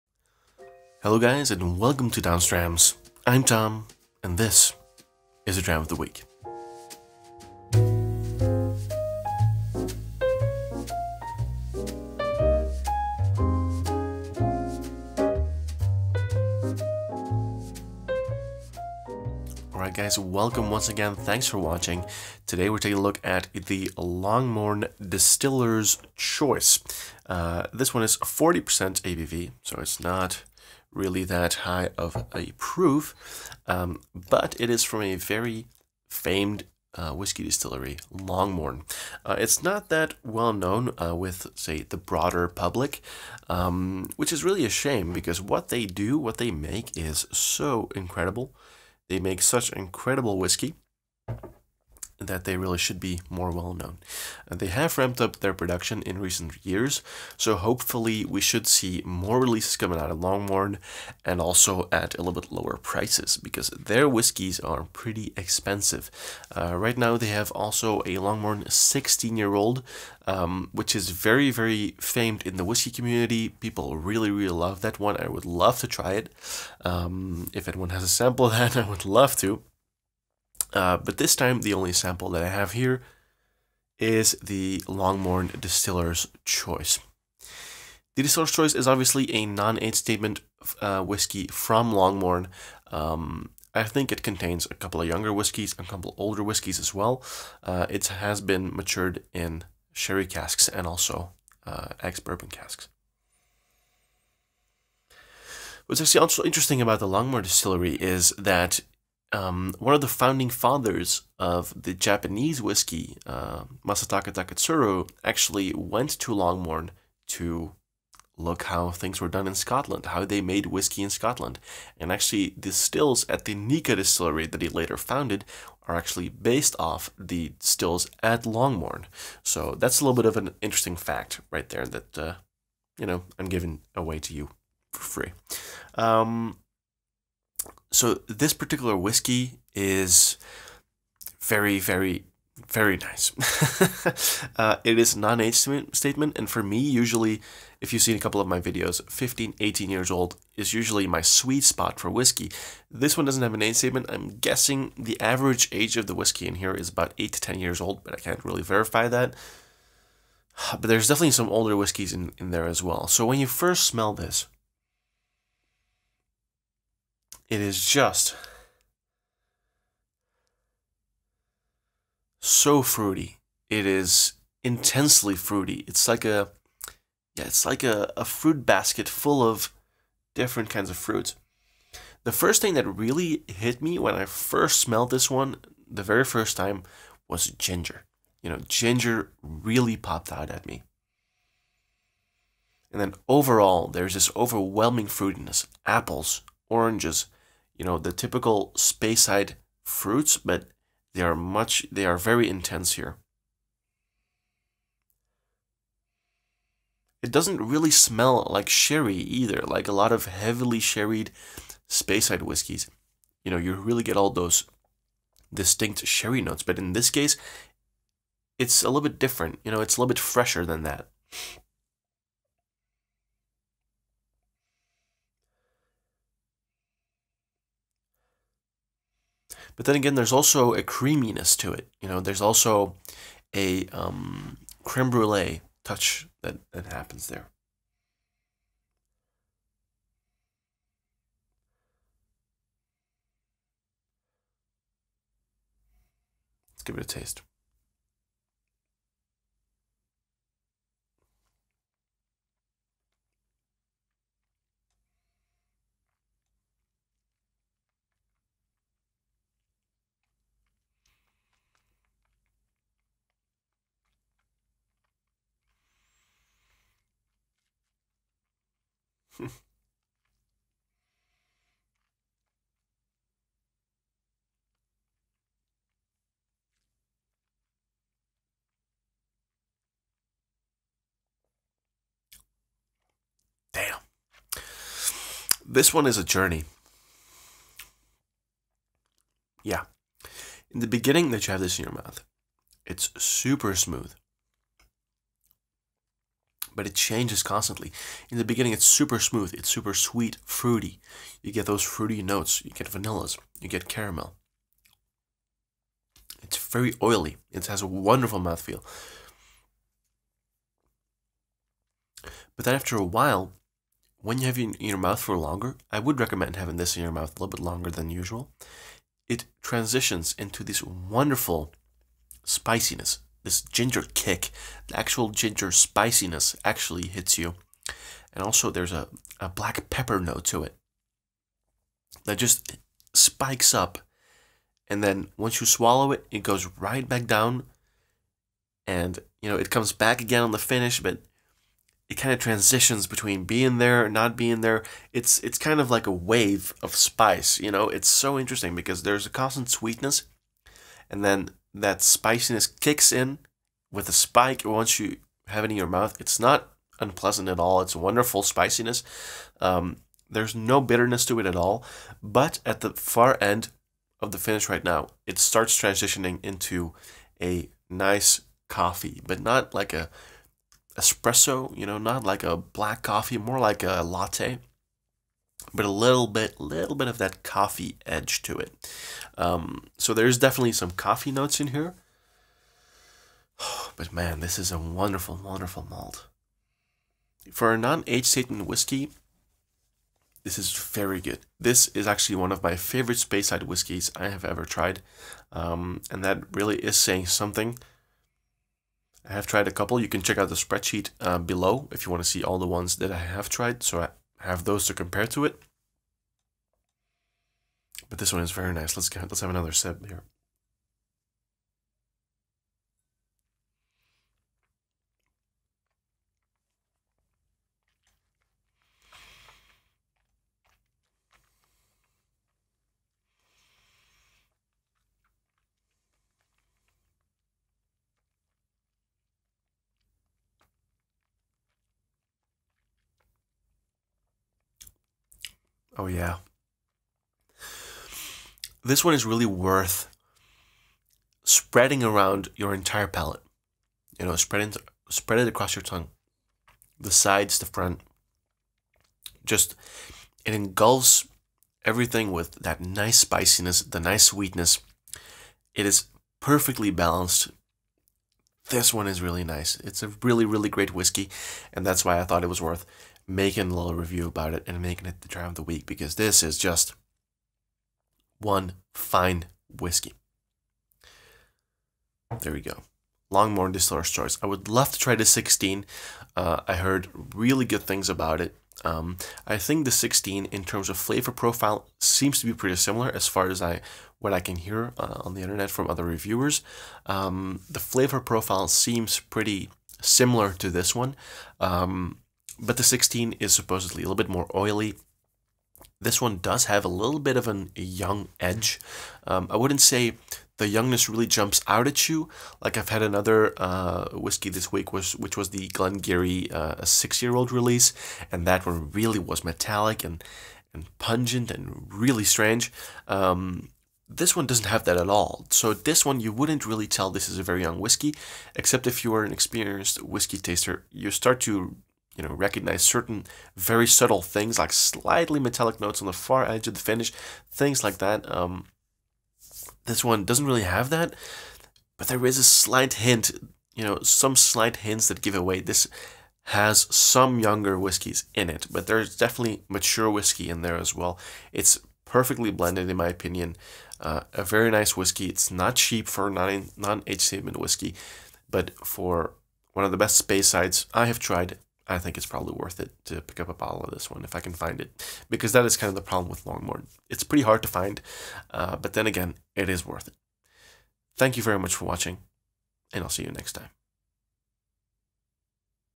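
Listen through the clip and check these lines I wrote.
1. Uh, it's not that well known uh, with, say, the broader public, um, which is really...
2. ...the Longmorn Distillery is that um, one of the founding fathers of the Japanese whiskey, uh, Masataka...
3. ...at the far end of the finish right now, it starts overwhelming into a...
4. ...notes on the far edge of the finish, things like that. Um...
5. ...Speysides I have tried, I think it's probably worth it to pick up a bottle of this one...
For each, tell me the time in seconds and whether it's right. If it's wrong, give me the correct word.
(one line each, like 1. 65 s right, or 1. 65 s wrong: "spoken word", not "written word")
1. 39 s right
2. 106 s right
3. 362 s wrong: "transitioning", not "overwhelming"
4. 525 s right
5. 550 s right.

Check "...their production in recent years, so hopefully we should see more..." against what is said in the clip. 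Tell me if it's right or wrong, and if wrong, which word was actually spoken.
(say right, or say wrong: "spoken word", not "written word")
right.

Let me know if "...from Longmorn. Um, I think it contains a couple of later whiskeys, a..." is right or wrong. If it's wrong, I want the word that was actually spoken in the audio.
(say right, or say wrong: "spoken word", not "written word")
wrong: "younger", not "later".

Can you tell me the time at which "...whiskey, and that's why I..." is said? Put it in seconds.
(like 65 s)
460 s.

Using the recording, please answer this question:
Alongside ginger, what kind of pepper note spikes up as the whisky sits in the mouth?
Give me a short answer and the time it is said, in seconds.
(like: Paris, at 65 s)
Black pepper, at 329 s.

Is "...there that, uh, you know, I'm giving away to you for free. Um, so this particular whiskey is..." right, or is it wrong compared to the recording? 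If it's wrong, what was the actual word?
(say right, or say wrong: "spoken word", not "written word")
right.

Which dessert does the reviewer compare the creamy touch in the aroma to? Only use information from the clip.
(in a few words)
Creme brulee.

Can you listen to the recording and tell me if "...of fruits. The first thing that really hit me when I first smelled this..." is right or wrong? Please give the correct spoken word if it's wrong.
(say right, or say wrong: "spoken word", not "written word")
right.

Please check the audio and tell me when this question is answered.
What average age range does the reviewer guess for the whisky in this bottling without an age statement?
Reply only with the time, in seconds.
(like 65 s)
157 s.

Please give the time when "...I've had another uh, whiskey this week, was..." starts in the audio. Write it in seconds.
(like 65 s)
502 s.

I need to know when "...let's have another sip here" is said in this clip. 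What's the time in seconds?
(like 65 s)
409 s.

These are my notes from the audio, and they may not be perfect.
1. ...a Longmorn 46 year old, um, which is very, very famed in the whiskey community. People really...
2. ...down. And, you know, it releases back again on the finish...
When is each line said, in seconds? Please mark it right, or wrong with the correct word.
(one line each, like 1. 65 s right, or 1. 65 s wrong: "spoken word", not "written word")
1. 68 s wrong: "16", not "46"
2. 337 s wrong: "comes", not "releases".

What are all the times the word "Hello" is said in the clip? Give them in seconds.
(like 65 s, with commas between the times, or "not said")
1 s.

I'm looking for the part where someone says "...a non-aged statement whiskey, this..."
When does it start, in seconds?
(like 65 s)
387 s.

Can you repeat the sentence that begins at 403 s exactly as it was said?
So I, have those to compare to it.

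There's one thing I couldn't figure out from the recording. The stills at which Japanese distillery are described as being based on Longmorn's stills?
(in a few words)
Nikka.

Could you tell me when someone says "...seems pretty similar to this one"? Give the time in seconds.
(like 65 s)
488 s.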